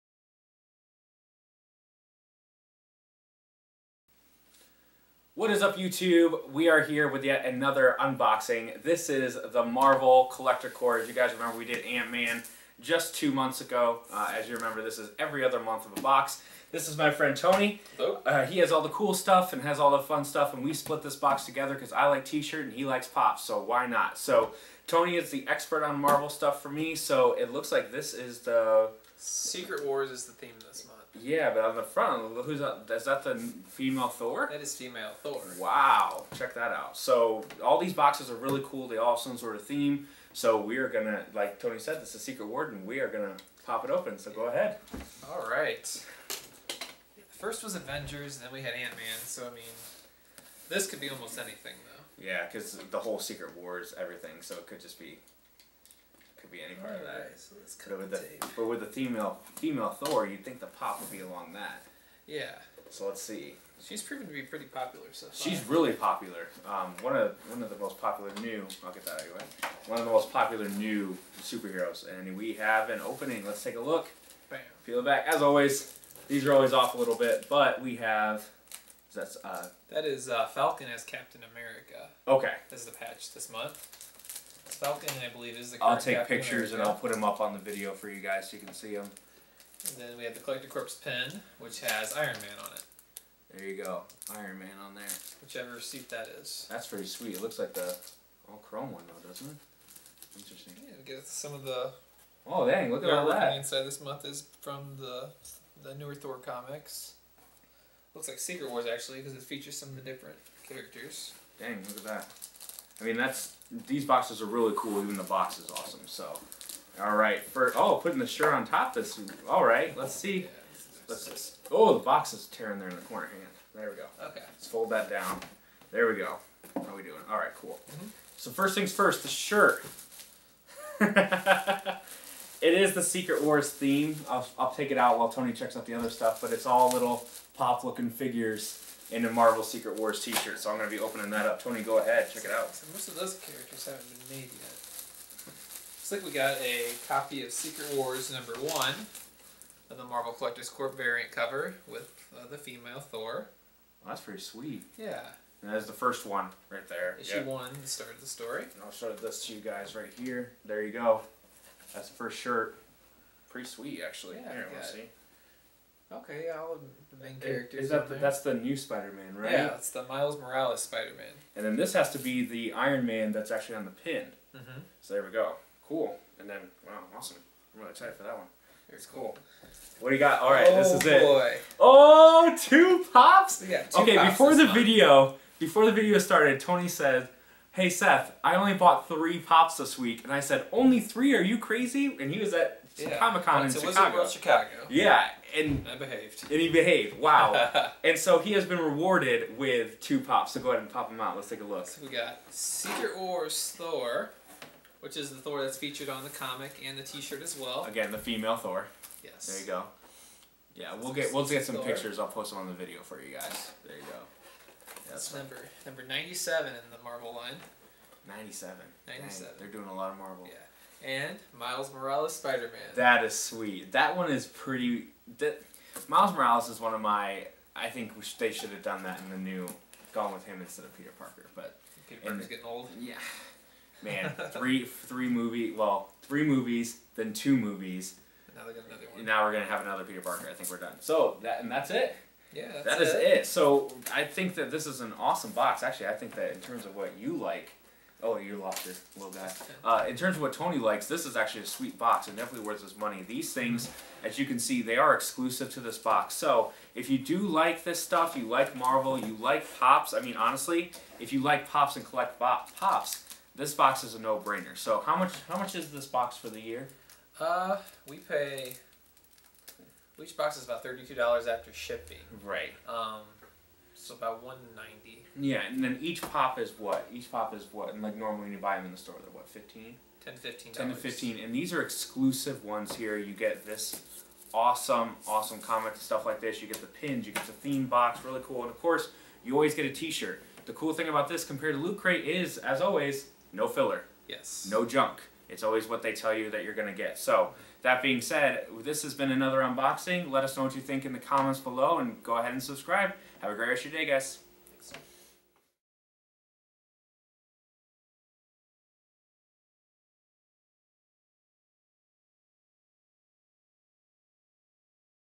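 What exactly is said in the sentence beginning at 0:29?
Secret War is the theme this month.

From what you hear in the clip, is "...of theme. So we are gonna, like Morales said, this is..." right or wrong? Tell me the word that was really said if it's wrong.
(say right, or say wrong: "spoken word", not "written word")
wrong: "Tony", not "Morales".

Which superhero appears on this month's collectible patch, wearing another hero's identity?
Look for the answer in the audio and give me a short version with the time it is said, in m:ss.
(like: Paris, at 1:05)
Falcon as Captain America, at 1:20.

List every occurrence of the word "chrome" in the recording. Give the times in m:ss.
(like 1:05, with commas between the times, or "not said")
1:38.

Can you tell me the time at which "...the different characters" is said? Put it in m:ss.
1:49.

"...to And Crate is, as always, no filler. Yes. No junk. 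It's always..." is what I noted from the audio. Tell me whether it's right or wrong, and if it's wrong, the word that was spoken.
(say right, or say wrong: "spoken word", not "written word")
wrong: "Loot", not "And".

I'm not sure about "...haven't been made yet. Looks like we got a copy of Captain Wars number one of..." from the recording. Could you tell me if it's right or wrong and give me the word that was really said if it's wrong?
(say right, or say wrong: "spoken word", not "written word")
wrong: "Secret", not "Captain".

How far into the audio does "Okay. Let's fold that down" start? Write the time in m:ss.
2:04.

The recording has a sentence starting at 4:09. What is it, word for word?
Uh, in terms of what Tony likes, this is actually a sweet box and definitely worth his money.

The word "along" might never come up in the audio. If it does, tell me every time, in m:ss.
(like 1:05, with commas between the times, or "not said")
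1:01.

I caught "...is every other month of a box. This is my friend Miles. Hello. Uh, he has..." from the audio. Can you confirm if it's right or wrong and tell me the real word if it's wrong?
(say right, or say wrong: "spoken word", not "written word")
wrong: "Tony", not "Miles".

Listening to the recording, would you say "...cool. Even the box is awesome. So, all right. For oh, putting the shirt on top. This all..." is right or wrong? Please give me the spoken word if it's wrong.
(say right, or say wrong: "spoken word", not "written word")
right.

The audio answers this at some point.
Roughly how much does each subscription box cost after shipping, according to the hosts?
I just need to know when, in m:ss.
4:30.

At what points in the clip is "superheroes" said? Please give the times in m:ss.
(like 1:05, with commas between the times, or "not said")
1:11.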